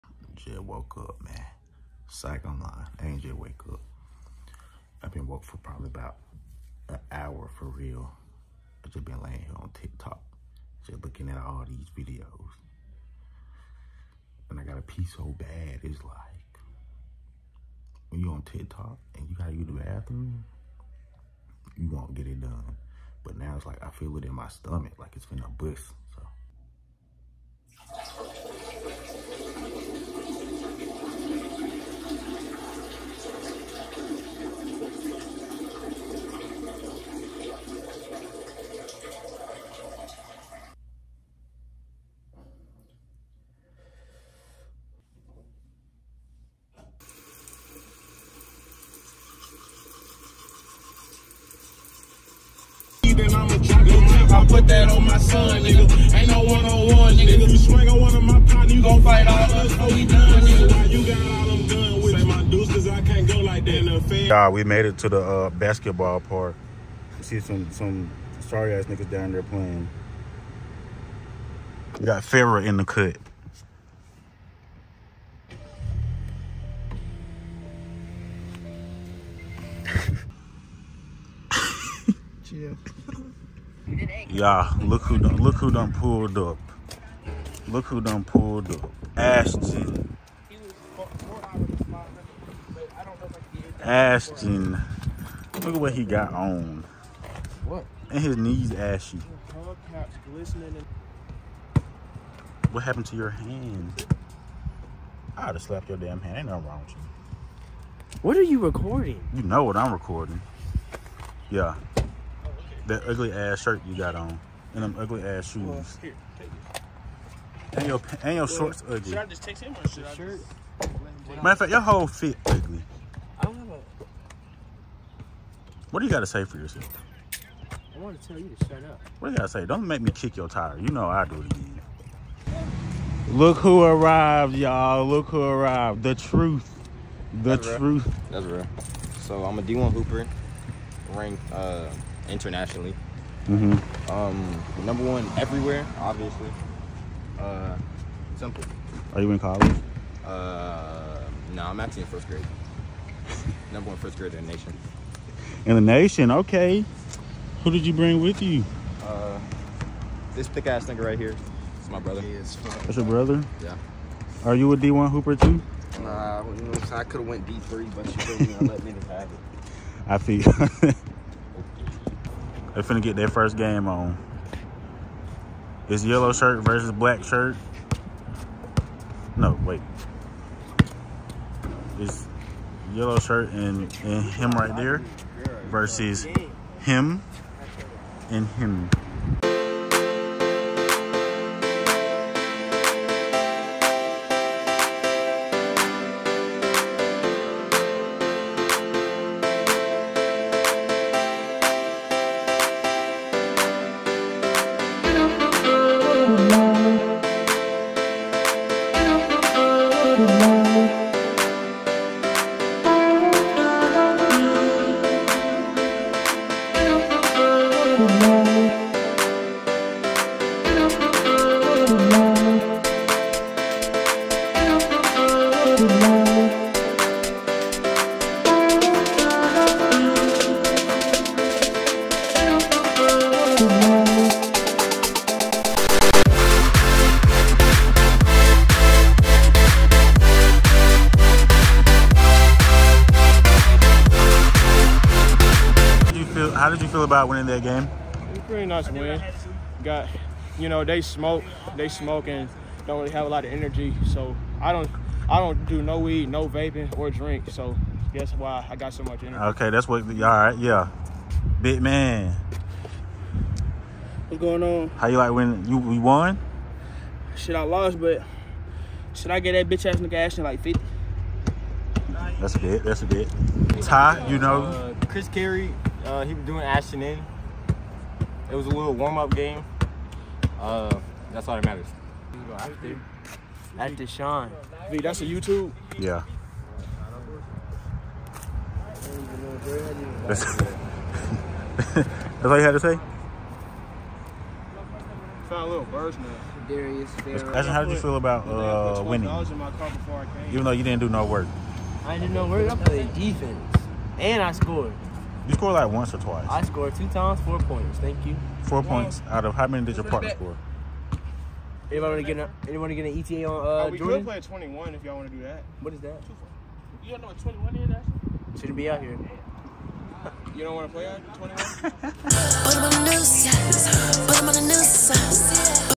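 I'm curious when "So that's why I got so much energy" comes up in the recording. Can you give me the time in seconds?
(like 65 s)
257 s.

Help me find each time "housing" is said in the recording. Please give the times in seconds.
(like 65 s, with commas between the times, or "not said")
not said.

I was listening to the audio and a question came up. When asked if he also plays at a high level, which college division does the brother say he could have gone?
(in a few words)
D3.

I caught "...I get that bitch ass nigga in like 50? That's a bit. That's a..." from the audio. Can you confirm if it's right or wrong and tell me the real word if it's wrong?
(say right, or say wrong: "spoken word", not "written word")
right.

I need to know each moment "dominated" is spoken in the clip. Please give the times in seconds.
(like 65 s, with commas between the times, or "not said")
not said.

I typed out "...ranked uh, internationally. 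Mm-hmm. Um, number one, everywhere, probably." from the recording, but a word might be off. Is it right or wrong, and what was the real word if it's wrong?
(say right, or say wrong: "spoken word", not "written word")
wrong: "obviously", not "probably".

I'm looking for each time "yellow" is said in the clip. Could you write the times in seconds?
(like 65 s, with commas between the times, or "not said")
176 s, 182 s.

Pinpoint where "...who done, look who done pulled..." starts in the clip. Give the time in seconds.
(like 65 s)
85 s.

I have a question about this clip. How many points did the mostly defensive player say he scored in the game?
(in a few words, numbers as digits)
4.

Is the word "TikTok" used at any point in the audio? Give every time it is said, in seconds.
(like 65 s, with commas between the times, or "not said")
9 s, 18 s.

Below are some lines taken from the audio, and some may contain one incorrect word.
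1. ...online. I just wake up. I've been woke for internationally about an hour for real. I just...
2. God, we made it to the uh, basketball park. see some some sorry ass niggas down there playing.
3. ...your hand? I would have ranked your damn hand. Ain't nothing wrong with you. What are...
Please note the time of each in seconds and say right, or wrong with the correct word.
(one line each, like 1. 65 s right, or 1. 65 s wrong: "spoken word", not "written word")
1. 2 s wrong: "probably", not "internationally"
2. 64 s right
3. 103 s wrong: "slapped", not "ranked".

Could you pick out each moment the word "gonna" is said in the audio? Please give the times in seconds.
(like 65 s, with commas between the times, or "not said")
25 s.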